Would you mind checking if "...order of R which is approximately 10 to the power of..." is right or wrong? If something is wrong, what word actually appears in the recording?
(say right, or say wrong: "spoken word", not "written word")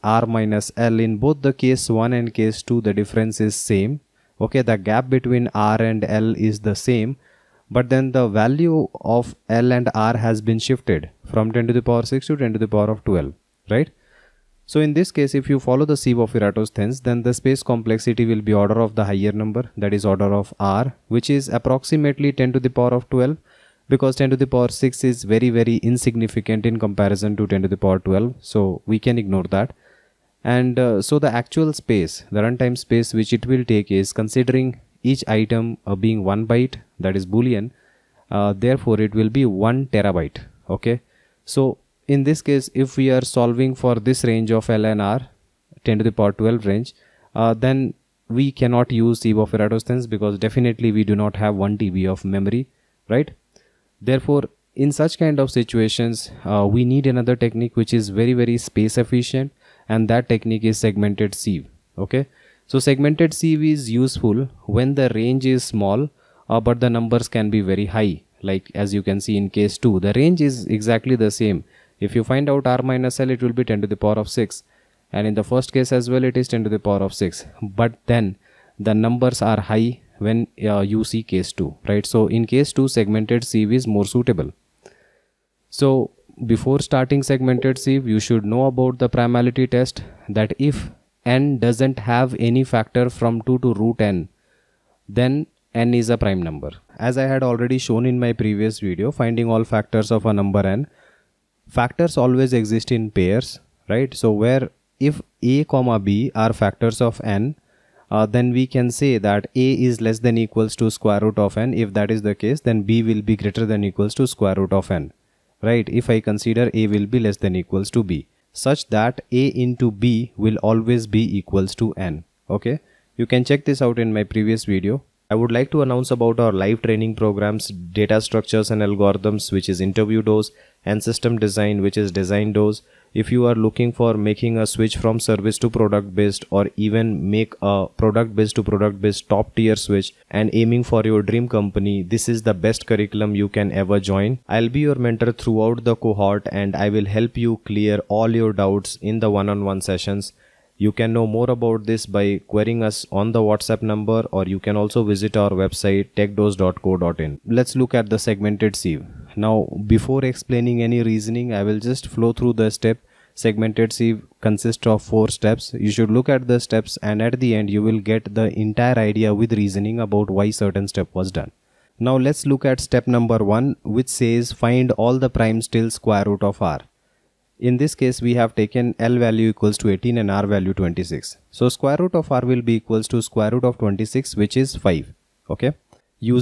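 right.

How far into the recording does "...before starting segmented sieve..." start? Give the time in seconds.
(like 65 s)
86 s.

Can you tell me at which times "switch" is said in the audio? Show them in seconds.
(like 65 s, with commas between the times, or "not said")
134 s, 139 s.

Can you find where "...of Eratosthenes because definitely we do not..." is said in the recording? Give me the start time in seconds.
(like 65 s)
49 s.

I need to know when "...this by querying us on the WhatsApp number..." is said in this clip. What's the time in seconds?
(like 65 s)
151 s.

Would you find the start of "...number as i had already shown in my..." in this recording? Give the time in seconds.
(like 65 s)
96 s.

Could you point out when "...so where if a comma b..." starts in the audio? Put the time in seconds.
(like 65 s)
104 s.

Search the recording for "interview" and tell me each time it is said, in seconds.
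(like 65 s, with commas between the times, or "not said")
129 s.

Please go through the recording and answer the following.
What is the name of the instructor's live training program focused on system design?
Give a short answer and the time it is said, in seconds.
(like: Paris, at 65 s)
design dose, at 132 s.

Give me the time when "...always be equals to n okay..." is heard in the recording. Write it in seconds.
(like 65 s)
120 s.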